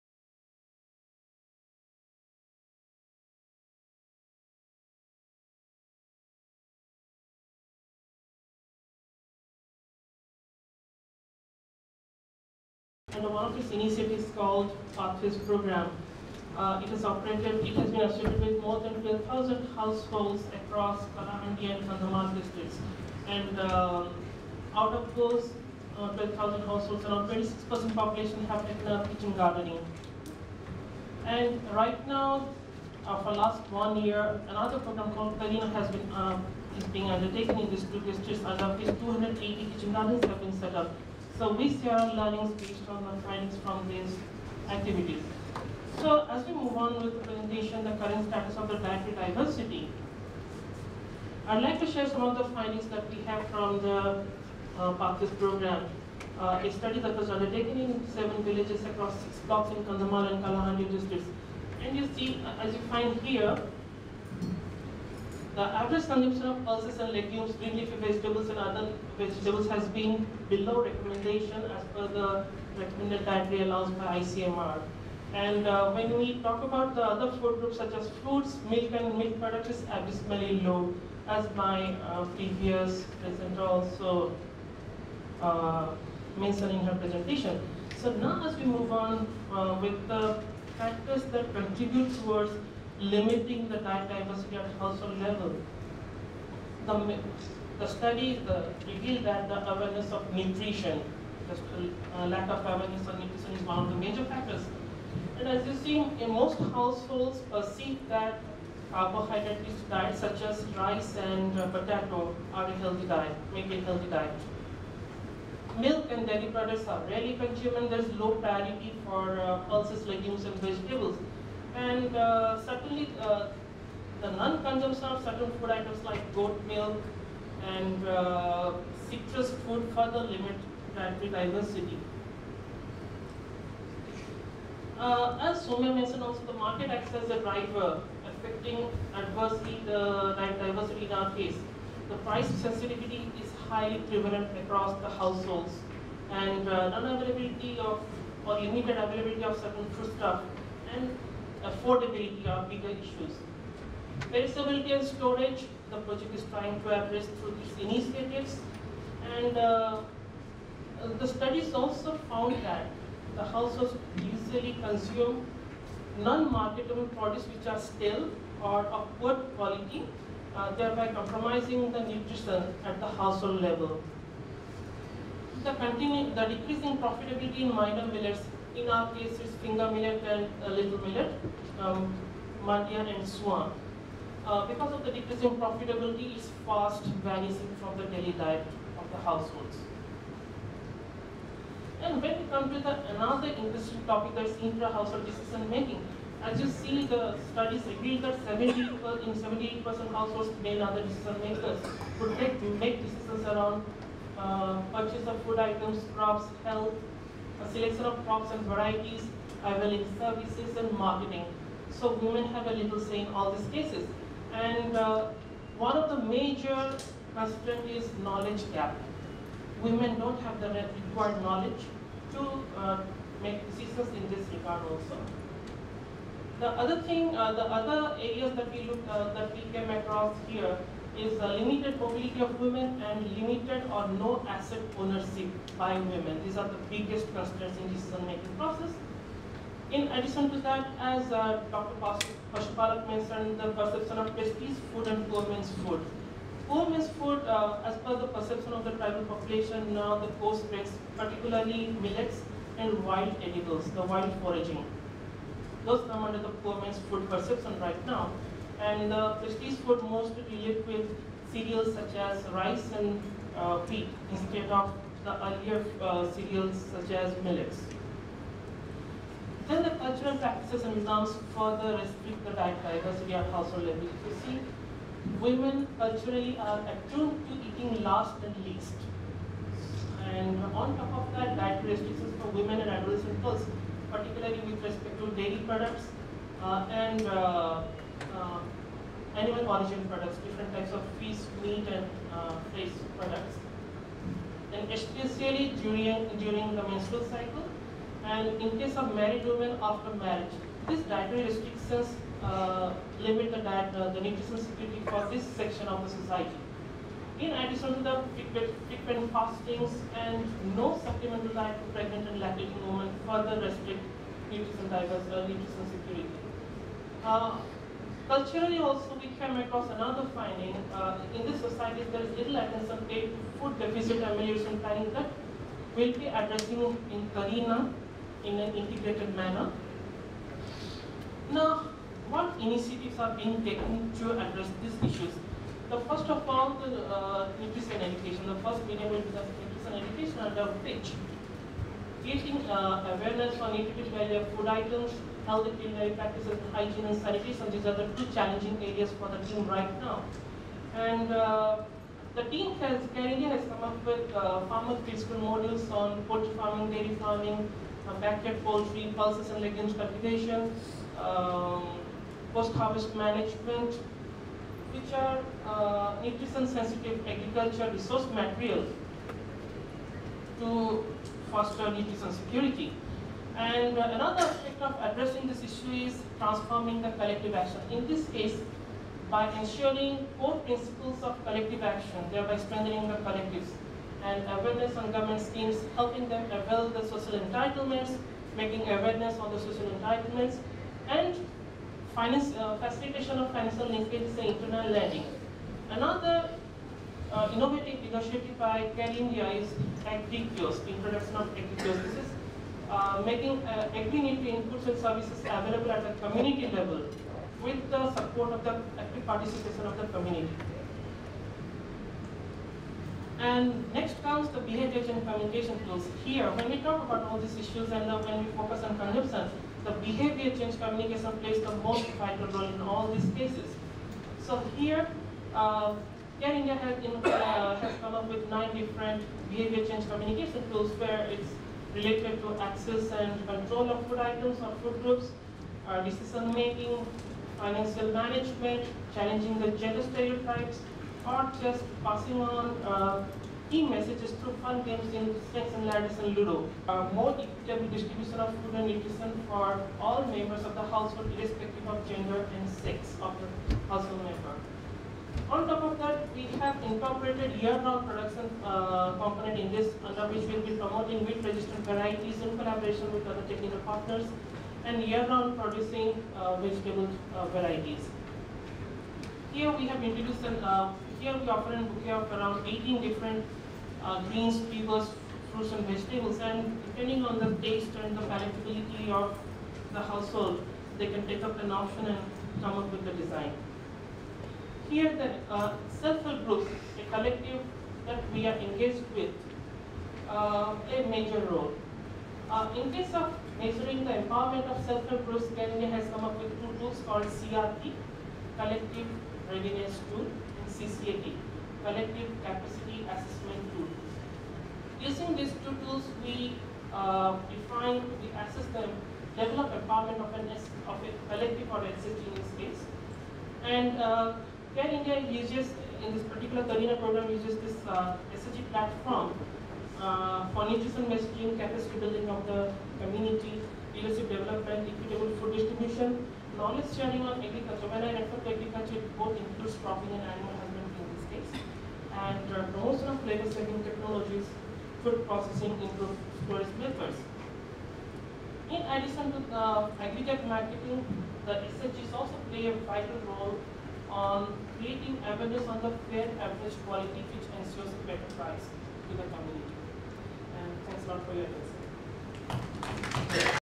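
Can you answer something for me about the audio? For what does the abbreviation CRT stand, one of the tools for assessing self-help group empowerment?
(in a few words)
Collective Readiness Tool.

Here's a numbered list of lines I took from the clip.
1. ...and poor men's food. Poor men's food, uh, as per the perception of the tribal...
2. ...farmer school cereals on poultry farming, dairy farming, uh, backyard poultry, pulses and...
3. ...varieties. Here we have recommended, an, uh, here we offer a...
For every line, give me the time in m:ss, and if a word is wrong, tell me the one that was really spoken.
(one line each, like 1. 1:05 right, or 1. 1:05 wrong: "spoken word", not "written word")
1. 4:05 right
2. 5:54 wrong: "models", not "cereals"
3. 7:47 wrong: "introduced", not "recommended".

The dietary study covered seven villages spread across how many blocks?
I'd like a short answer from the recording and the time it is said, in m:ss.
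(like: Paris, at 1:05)
6, at 0:59.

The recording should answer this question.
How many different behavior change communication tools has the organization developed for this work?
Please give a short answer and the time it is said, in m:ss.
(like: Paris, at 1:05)
9, at 7:08.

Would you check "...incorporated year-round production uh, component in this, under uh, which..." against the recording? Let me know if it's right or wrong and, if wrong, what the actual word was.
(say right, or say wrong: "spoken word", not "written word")
right.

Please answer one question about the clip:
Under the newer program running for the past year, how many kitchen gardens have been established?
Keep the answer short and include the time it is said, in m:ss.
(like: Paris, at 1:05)
280, at 0:38.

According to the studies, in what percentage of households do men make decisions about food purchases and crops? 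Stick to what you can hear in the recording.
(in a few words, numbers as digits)
78%.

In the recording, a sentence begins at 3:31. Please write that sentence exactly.
So women have a little say in all these cases.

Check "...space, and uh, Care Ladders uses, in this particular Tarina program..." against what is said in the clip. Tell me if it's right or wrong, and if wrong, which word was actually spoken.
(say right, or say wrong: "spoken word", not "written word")
wrong: "India", not "Ladders".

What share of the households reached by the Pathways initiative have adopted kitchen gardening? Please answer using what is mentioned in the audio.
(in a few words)
26%.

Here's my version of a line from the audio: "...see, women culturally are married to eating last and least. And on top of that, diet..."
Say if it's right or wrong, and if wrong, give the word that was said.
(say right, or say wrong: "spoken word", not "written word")
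wrong: "attuned", not "married".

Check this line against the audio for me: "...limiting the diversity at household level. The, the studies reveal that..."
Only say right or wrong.
right.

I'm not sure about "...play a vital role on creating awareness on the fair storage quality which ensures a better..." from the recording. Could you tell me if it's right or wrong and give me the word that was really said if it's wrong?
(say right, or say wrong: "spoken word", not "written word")
wrong: "average", not "storage".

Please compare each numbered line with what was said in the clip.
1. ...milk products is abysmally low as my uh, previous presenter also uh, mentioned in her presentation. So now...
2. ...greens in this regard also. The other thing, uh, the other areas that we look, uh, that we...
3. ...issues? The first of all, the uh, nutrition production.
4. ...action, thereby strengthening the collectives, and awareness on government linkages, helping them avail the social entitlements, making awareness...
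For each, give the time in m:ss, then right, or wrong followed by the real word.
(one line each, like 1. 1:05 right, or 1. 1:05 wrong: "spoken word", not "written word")
1. 1:19 right
2. 3:43 wrong: "decisions", not "greens"
3. 5:35 wrong: "education", not "production"
4. 6:21 wrong: "schemes", not "linkages".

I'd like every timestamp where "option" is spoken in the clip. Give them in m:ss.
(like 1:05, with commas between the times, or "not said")
8:01.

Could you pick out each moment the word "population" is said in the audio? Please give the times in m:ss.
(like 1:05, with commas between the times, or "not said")
0:27, 4:09.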